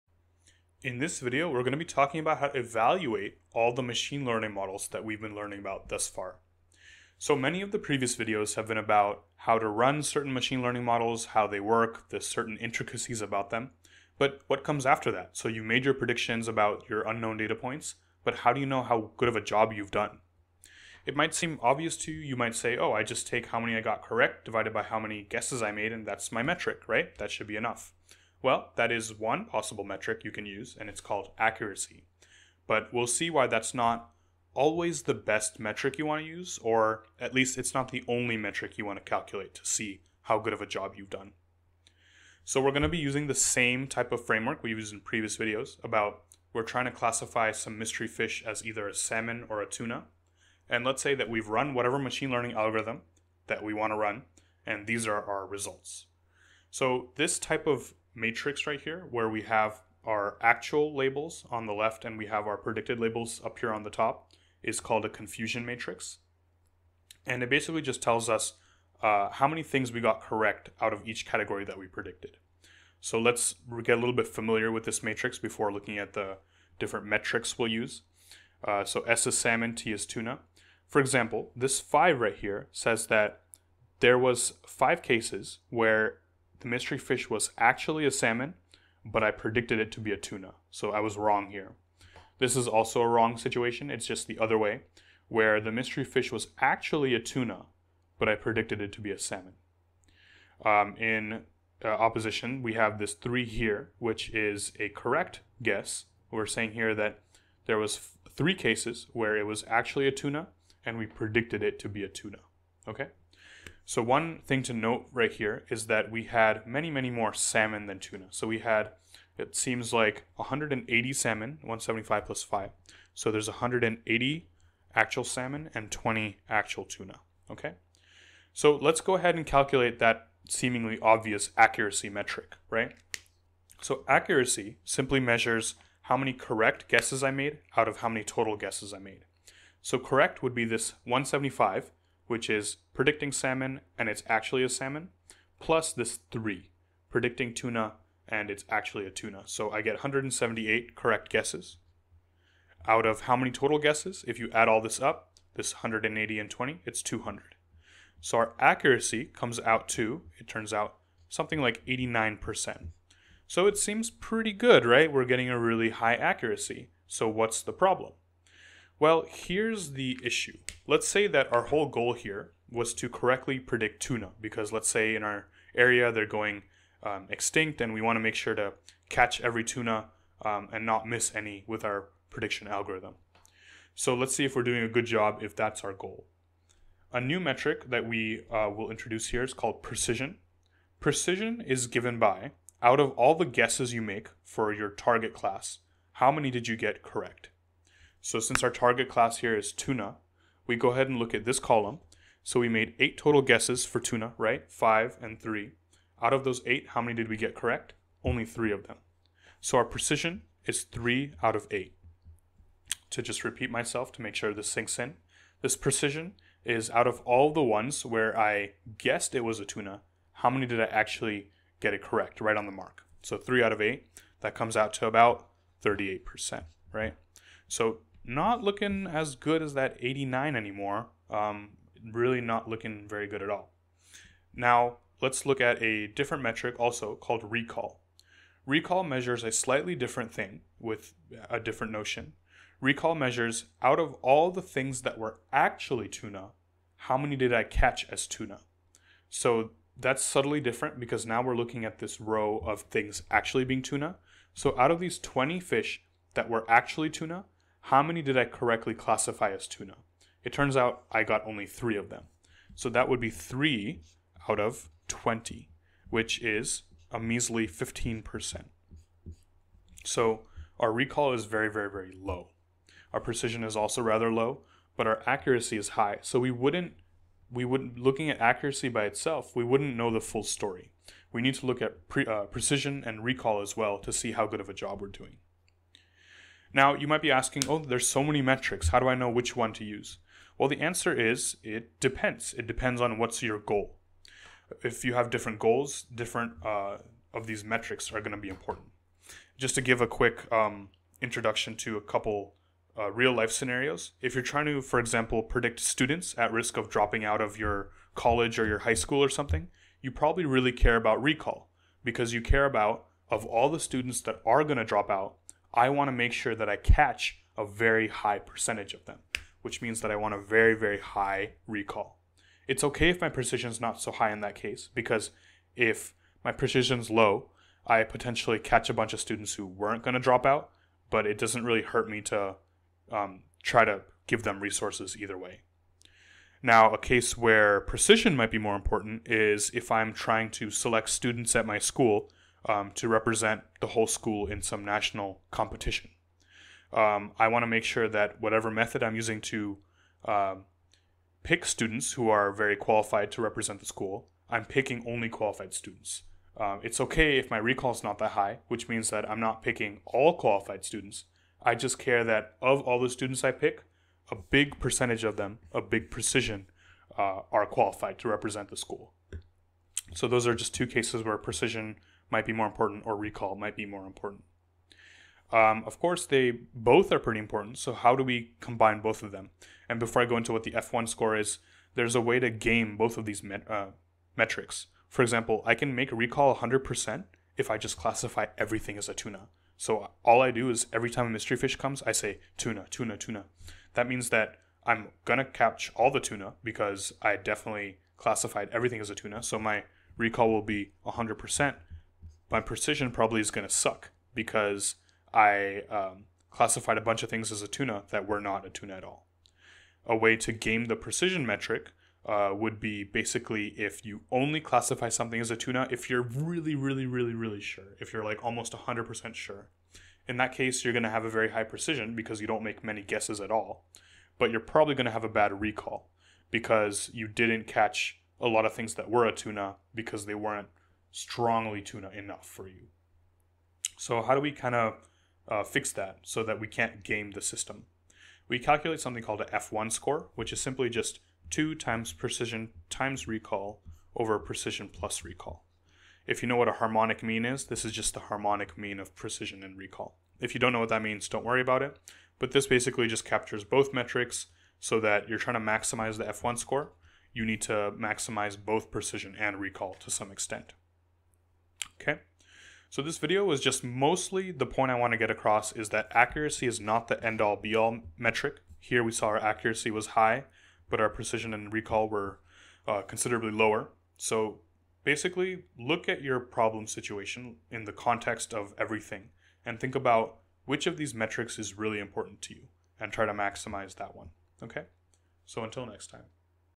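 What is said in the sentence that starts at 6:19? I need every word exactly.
And before I go into what the F1 score is, there's a way to game both of these met- uh, metrics.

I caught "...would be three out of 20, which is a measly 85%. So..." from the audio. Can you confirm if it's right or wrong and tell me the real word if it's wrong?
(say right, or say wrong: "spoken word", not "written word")
wrong: "15", not "85".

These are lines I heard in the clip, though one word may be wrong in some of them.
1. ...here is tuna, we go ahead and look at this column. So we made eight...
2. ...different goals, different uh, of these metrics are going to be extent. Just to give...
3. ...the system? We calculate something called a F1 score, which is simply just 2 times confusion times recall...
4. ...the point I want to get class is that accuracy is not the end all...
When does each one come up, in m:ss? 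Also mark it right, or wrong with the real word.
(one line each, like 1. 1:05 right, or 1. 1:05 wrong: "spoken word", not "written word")
1. 3:19 right
2. 4:55 wrong: "important", not "extent"
3. 7:17 wrong: "precision", not "confusion"
4. 7:44 wrong: "across", not "class".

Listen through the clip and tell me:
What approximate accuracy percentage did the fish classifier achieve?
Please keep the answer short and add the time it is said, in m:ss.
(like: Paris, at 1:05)
89%, at 2:41.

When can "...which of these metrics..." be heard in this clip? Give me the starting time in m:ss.
8:00.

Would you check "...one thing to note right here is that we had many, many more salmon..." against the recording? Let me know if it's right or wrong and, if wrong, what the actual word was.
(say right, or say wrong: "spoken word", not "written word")
right.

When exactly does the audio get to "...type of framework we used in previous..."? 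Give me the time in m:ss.
0:43.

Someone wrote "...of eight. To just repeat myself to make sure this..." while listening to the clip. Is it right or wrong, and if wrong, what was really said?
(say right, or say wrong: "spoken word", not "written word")
right.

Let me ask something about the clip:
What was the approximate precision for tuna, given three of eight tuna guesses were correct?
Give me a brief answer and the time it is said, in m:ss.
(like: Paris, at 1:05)
38%, at 3:45.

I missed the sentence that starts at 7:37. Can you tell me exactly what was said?
You need to maximize both precision and recall to some extent.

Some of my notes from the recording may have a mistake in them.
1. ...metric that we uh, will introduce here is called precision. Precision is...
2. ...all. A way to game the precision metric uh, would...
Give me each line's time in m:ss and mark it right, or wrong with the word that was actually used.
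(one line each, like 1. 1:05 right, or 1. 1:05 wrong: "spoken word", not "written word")
1. 3:07 right
2. 6:49 right.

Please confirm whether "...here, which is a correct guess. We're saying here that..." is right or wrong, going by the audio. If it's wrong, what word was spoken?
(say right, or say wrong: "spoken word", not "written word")
right.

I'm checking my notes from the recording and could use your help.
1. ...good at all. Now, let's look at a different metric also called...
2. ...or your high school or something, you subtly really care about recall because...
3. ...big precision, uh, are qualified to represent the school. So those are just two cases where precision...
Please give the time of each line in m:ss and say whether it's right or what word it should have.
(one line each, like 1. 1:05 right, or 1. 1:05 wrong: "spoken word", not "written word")
1. 3:53 right
2. 5:08 wrong: "probably", not "subtly"
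3. 6:05 right.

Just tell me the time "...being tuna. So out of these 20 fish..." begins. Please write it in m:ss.
4:13.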